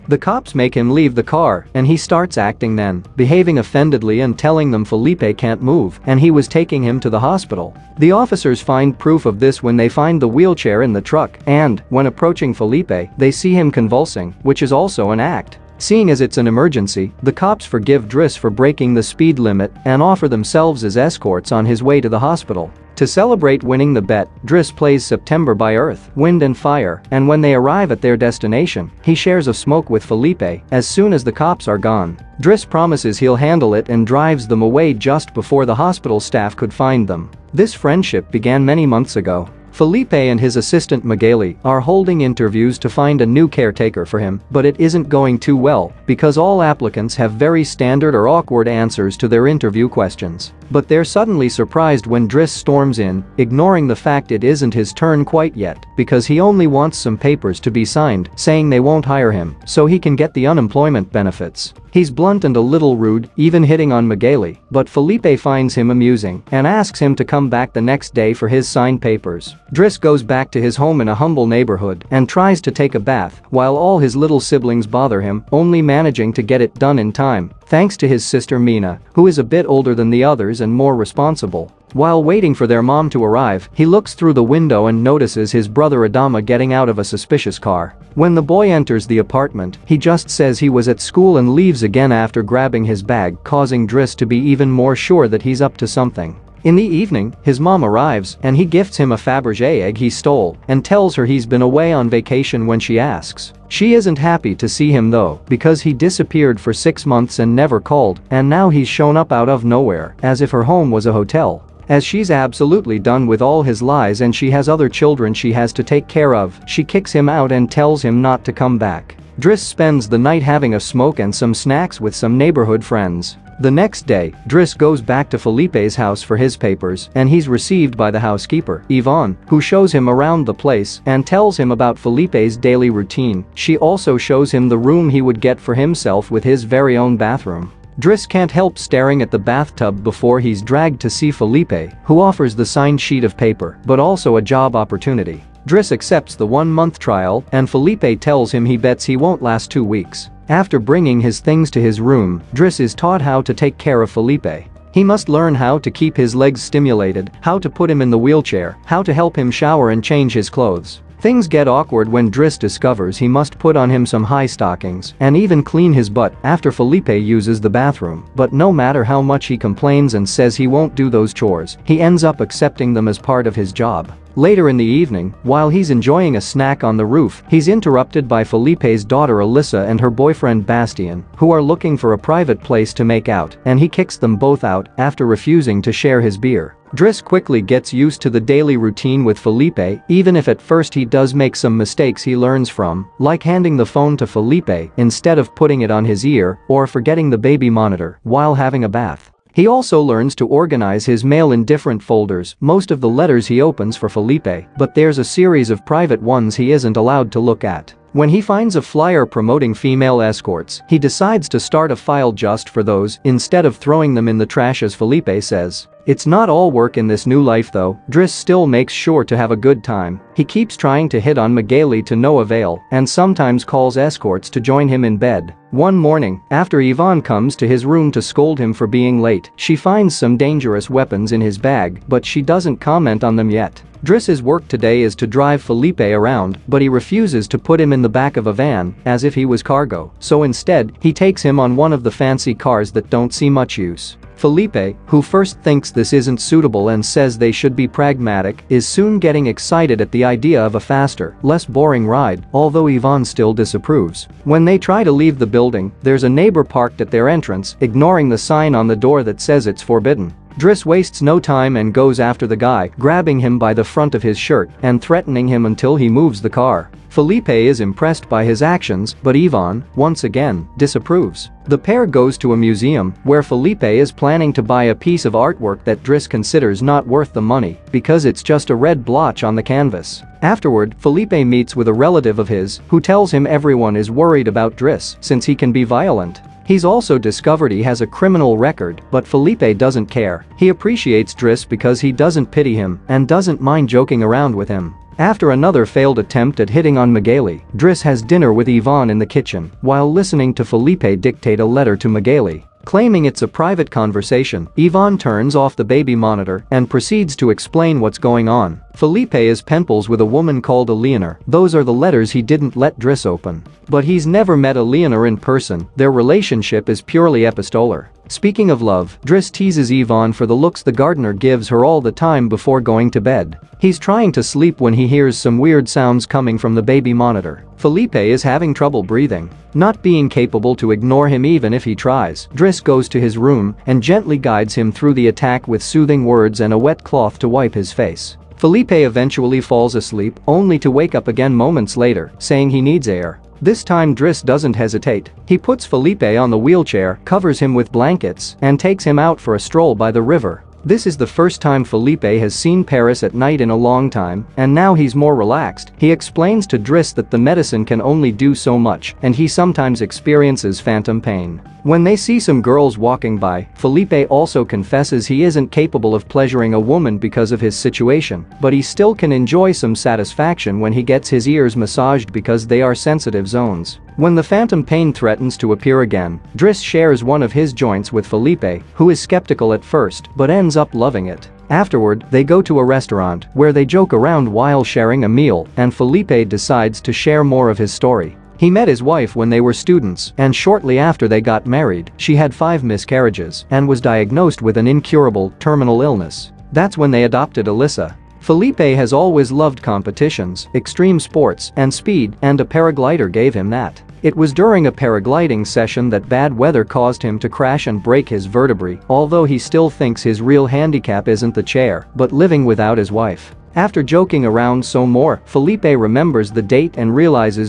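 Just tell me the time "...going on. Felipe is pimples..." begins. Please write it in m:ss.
5:08.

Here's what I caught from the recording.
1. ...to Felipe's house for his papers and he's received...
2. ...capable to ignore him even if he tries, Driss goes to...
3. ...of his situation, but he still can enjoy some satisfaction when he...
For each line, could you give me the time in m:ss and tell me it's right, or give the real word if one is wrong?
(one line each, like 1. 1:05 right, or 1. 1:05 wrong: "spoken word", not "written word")
1. 2:05 right
2. 5:30 right
3. 6:07 right.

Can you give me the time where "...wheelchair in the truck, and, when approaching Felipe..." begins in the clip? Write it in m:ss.
0:10.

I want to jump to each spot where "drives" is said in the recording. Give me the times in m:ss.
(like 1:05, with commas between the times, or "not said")
0:34, 3:55.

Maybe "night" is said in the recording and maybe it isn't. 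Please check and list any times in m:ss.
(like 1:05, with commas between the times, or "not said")
2:00, 5:53.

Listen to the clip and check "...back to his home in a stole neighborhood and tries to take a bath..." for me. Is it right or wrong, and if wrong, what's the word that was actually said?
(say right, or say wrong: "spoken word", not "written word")
wrong: "humble", not "stole".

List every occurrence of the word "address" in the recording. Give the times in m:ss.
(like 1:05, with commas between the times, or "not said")
not said.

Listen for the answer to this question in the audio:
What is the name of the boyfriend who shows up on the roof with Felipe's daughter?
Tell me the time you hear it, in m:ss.
3:00.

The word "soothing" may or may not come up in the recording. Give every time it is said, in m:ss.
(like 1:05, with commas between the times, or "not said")
5:35.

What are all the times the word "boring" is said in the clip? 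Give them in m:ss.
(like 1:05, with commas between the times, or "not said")
4:11.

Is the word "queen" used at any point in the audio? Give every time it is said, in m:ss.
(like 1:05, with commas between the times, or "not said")
not said.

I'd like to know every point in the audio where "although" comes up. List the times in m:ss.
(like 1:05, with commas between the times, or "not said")
4:12, 6:49.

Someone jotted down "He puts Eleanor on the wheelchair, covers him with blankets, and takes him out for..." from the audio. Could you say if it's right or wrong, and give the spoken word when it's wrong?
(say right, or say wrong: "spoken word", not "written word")
wrong: "Felipe", not "Eleanor".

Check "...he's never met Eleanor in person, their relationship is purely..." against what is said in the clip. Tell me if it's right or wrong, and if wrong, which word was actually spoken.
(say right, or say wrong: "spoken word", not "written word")
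right.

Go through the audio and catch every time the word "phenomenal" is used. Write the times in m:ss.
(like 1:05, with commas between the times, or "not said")
not said.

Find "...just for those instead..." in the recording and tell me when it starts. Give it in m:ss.
3:32.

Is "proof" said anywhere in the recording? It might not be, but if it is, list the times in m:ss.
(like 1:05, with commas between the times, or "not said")
0:08.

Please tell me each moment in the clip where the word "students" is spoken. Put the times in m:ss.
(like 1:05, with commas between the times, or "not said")
6:29.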